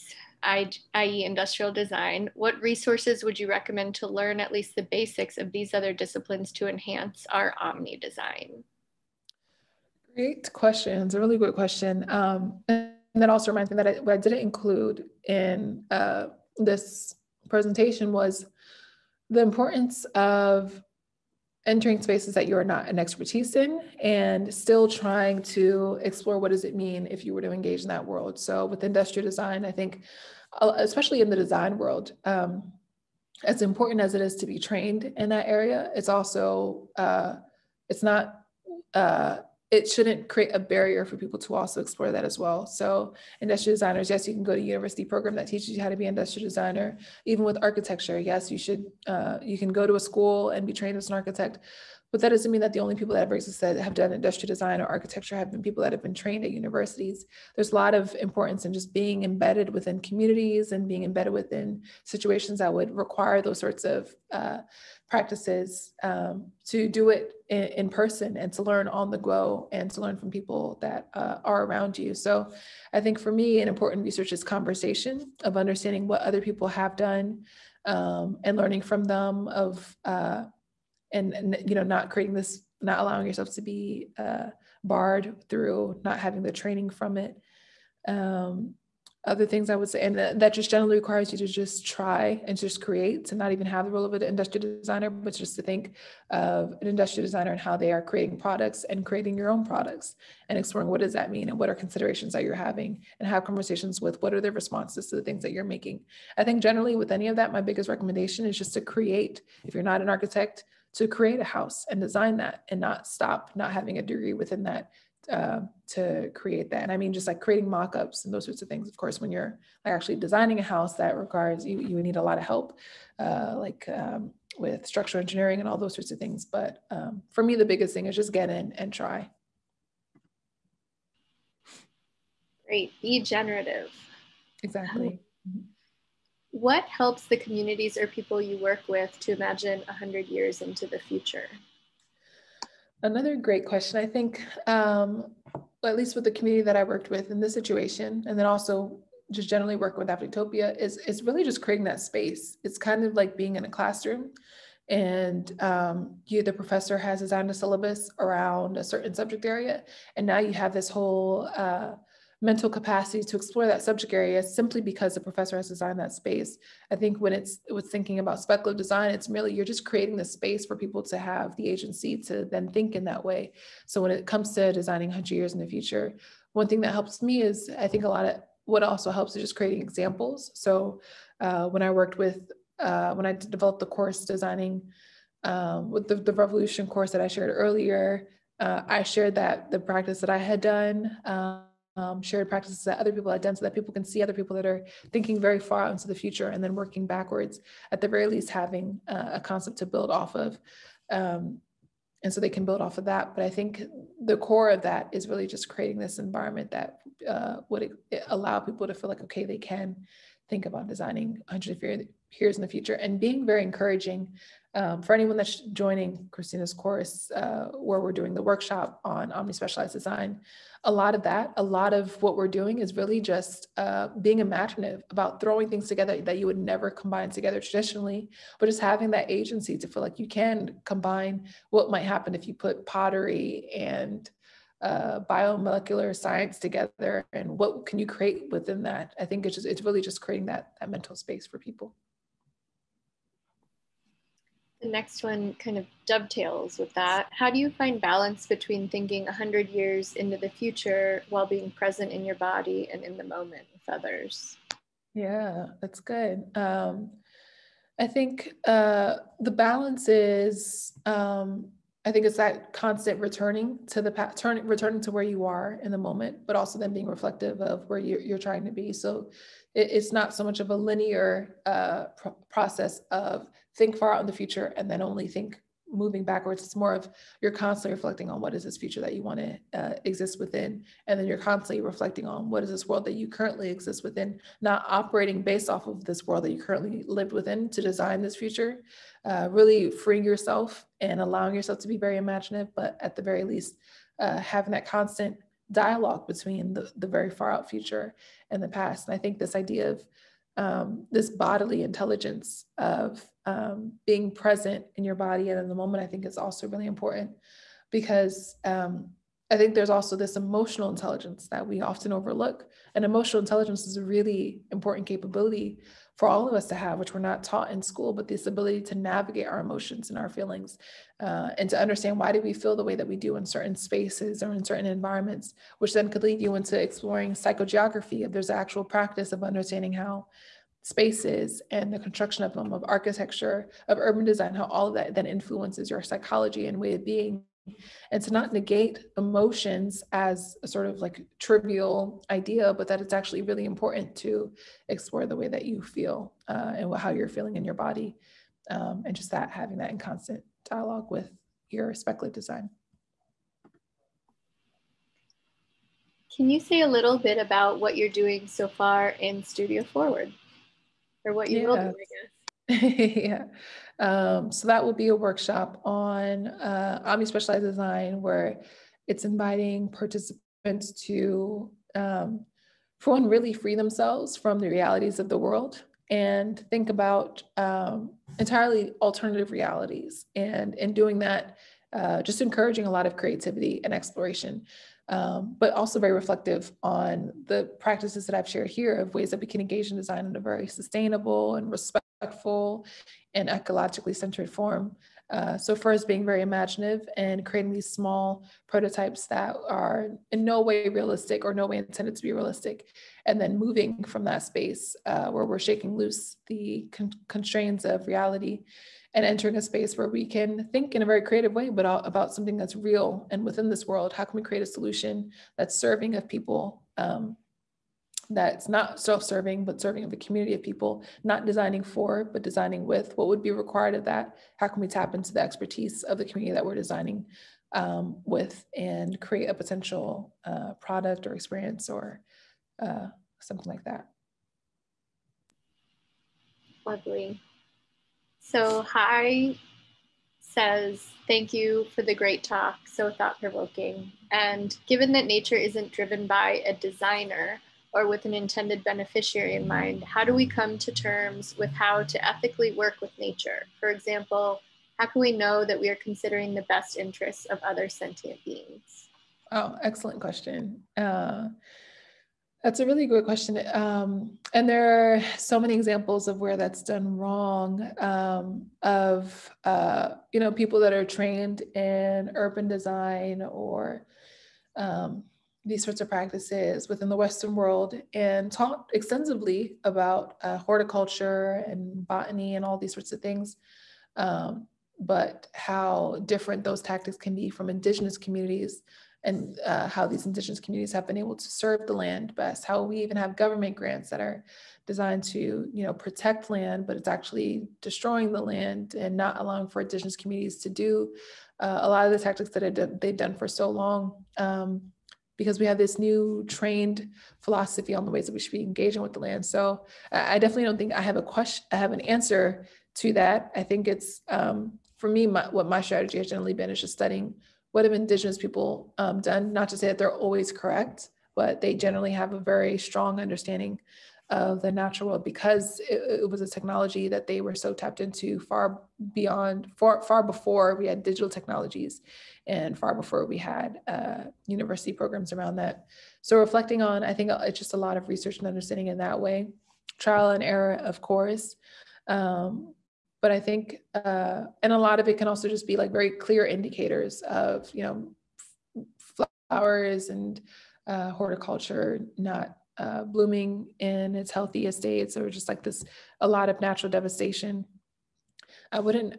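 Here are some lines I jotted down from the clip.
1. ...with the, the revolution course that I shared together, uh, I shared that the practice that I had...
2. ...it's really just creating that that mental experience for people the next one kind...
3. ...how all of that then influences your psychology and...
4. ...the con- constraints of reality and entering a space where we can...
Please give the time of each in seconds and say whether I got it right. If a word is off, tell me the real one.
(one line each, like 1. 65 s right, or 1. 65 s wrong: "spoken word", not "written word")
1. 185 s wrong: "earlier", not "together"
2. 239 s wrong: "space", not "experience"
3. 334 s right
4. 406 s right.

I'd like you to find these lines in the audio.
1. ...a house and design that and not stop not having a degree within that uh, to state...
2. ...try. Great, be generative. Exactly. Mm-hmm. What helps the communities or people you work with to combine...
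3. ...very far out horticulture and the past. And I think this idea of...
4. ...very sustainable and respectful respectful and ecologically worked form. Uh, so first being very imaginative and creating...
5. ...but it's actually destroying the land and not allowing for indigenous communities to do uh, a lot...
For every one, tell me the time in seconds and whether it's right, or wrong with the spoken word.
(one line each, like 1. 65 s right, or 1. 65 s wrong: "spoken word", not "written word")
1. 111 s wrong: "create", not "state"
2. 128 s wrong: "imagine", not "combine"
3. 297 s wrong: "future", not "horticulture"
4. 390 s wrong: "centered", not "worked"
5. 496 s right.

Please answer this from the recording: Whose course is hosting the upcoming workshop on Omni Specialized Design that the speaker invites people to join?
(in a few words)
Christina.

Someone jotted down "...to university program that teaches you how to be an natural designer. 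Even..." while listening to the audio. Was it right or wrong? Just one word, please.
wrong.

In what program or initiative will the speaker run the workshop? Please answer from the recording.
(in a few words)
Studio Forward.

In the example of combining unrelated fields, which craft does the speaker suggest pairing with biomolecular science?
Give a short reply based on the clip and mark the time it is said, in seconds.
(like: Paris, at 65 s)
pottery, at 232 s.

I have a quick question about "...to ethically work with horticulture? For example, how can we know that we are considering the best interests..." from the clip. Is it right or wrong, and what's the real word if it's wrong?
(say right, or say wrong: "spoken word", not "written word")
wrong: "nature", not "horticulture".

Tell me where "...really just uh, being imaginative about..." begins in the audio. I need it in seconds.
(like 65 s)
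222 s.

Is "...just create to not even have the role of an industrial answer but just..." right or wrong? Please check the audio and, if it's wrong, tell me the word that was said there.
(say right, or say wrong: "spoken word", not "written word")
wrong: "designer", not "answer".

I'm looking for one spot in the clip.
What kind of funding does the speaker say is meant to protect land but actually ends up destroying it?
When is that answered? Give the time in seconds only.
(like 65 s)
493 s.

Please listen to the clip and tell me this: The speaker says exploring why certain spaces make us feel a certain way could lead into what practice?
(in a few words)
psychogeography.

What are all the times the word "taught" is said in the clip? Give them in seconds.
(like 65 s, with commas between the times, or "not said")
317 s, 478 s.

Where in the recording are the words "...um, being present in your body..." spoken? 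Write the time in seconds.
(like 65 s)
303 s.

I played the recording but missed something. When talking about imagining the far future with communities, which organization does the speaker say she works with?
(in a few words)
Afrotectopia.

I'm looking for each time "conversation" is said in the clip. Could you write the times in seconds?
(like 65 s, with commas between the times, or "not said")
74 s, 103 s.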